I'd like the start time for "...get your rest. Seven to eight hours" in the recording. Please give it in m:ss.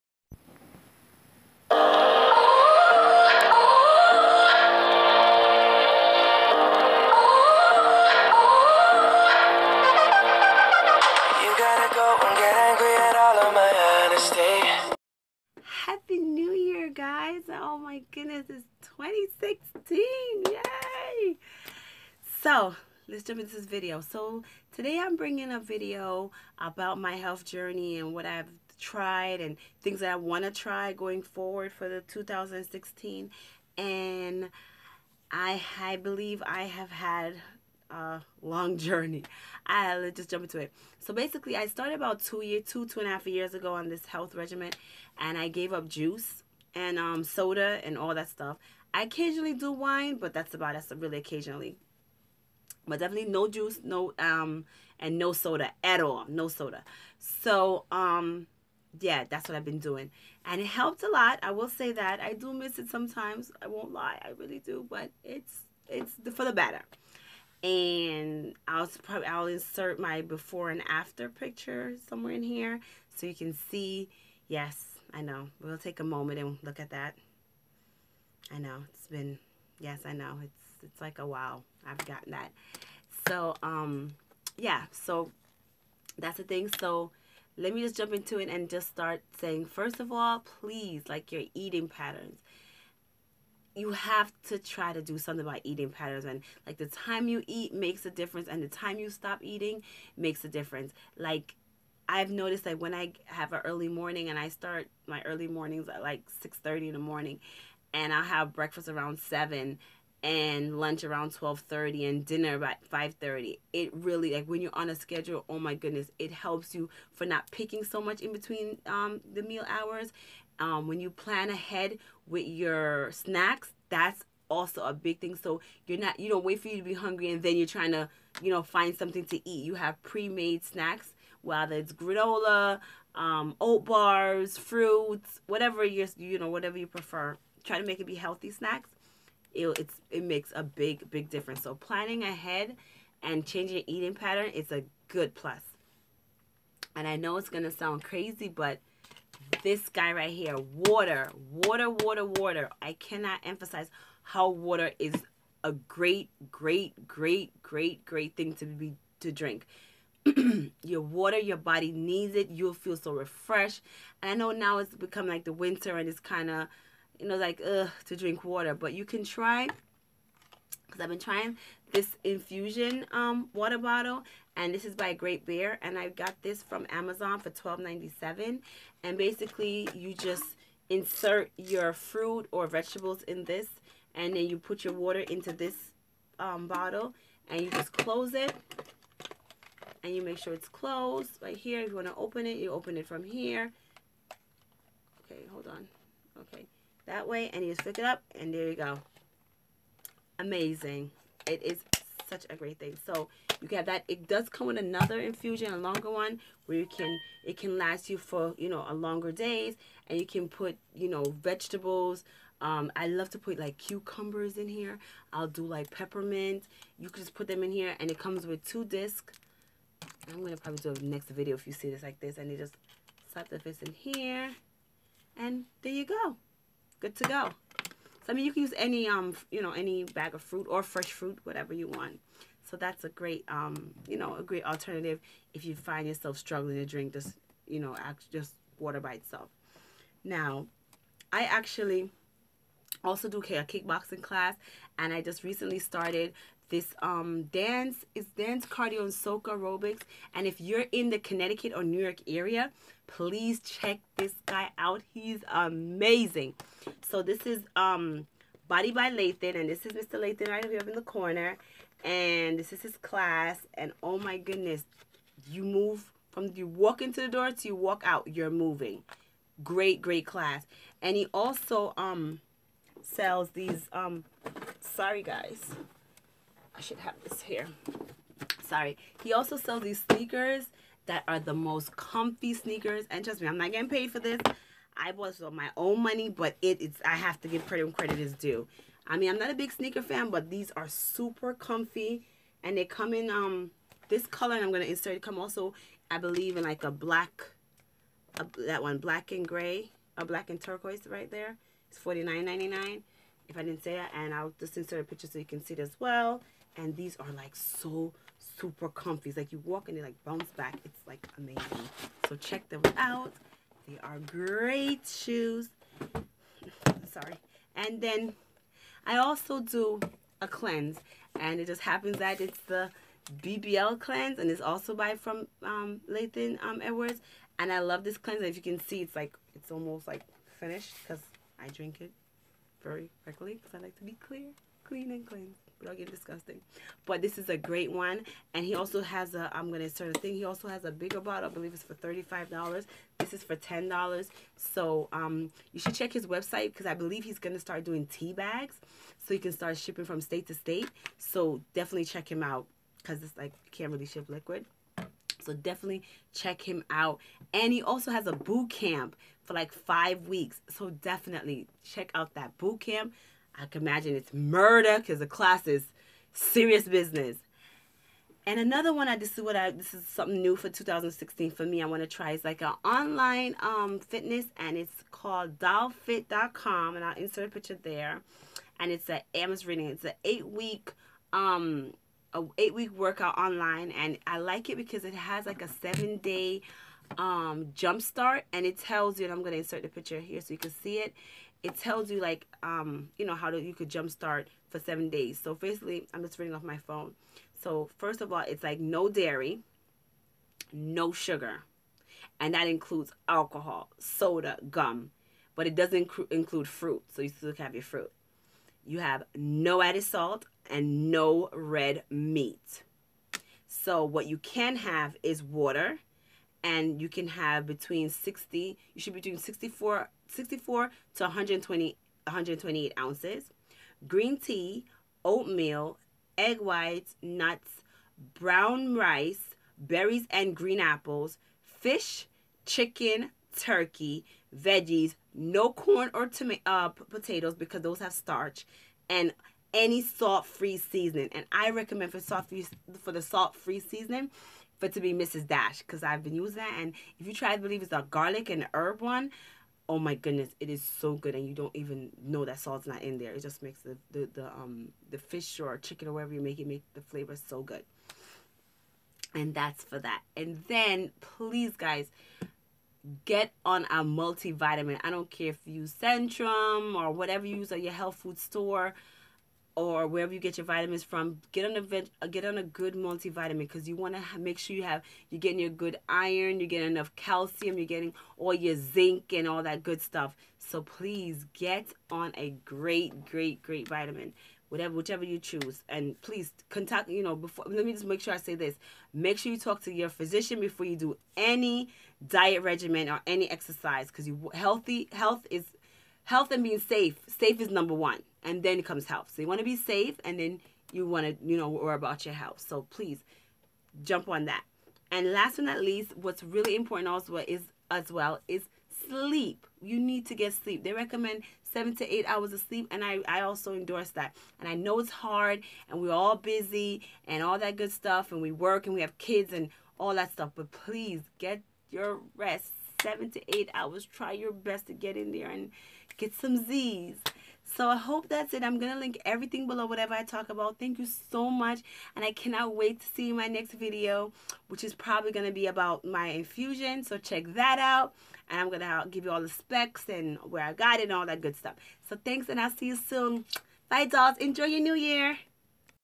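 8:41.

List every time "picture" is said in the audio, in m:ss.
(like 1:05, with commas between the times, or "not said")
1:11, 5:05, 6:17, 6:29.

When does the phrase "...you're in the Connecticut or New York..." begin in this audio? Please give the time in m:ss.
4:10.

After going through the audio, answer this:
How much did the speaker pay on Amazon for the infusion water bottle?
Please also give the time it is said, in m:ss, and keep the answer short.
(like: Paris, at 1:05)
$12.97, at 2:57.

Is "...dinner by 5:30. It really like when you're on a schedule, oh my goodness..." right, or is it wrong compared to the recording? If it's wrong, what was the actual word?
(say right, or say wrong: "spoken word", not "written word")
right.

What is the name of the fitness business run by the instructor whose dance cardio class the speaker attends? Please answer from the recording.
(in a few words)
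Body by Leighton.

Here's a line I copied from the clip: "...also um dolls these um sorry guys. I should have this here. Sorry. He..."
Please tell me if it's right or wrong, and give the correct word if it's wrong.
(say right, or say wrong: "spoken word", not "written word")
wrong: "sells", not "dolls".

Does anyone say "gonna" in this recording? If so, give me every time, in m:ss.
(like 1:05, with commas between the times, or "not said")
2:27, 6:29.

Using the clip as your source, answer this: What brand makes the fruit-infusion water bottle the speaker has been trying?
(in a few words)
Great Bear.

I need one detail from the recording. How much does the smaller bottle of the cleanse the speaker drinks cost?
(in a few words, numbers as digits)
$10.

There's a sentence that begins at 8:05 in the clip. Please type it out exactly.
And please contact you know before.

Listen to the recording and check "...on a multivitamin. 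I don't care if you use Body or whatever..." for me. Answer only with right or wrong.
wrong.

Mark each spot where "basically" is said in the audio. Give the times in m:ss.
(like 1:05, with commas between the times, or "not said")
0:41, 2:59, 6:35.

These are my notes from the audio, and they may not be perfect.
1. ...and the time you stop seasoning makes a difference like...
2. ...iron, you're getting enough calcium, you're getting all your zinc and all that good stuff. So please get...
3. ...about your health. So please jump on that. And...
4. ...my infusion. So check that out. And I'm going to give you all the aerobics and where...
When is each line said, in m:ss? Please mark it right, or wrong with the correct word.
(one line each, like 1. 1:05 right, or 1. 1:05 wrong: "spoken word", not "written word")
1. 1:38 wrong: "eating", not "seasoning"
2. 7:56 right
3. 8:21 right
4. 8:56 wrong: "specs", not "aerobics".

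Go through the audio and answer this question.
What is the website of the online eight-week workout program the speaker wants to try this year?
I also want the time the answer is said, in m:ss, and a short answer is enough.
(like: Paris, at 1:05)
dollfacefit.com, at 6:15.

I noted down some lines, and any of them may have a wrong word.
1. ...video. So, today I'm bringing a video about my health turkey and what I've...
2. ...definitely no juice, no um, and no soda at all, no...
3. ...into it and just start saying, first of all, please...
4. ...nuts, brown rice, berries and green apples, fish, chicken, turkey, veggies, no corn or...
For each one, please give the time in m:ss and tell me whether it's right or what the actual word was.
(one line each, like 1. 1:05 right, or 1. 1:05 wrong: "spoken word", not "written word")
1. 0:23 wrong: "journey", not "turkey"
2. 0:52 right
3. 1:28 right
4. 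7:07 right.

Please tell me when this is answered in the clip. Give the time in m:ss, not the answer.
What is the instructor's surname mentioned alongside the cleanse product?
5:26.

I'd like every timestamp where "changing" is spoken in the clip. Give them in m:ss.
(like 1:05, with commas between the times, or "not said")
2:23.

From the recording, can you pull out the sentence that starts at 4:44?
I bought this with my own money, but it, it's I have to give credit when credit is due.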